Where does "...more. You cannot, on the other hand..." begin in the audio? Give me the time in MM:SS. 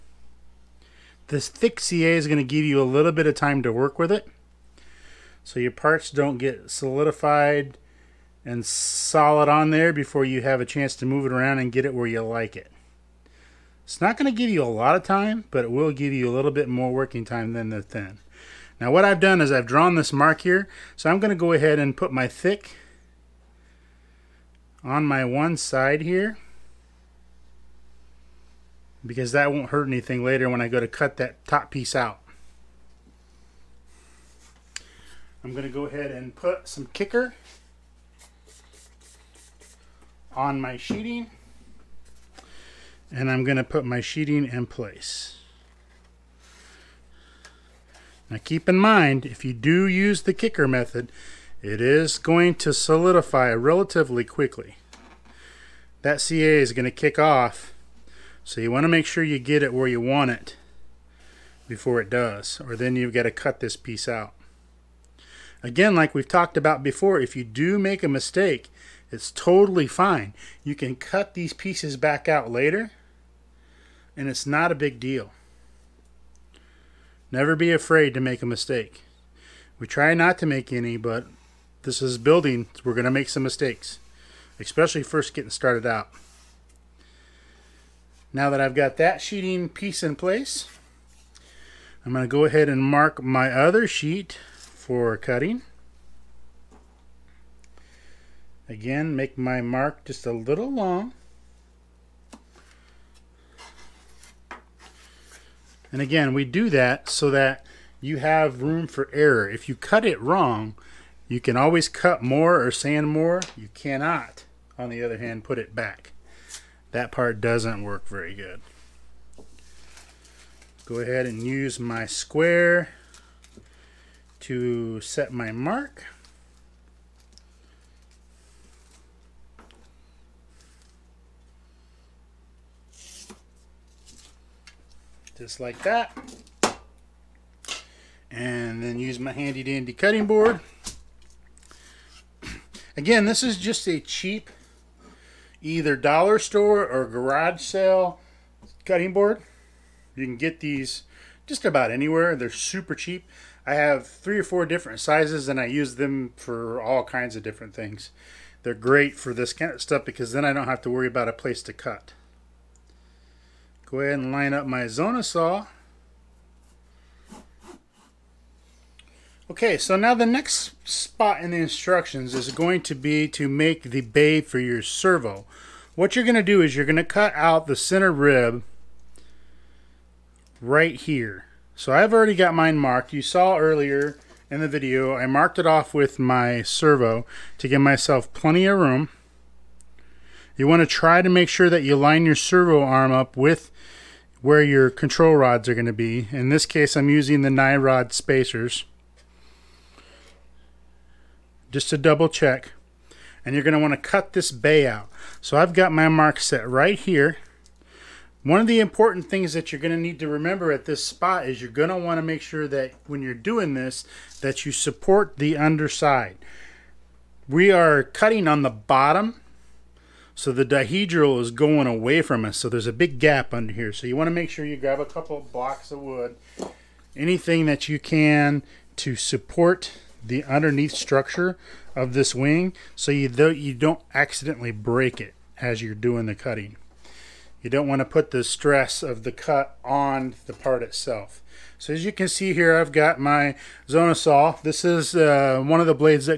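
01:53.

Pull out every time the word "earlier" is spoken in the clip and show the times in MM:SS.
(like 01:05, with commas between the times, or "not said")
03:03.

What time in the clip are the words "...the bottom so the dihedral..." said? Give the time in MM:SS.
03:38.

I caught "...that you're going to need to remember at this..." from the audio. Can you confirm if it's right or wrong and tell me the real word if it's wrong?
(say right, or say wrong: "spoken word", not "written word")
right.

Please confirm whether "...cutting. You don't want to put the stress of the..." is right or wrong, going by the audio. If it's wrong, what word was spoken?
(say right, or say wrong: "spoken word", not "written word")
right.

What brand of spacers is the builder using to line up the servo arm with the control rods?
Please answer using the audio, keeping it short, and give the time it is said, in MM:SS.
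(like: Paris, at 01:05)
Nyrod, at 03:17.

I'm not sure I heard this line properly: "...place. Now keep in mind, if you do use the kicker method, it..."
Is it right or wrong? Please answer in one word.
right.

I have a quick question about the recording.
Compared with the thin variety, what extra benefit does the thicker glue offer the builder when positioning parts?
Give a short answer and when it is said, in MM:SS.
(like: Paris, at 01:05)
more working time, at 00:16.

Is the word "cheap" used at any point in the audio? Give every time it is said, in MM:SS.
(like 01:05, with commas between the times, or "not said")
02:23, 02:32.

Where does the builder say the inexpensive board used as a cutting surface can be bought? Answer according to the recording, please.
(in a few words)
dollar store or garage sale.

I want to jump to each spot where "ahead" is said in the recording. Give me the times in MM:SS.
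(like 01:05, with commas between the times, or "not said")
00:21, 00:35, 01:32, 02:00, 02:43.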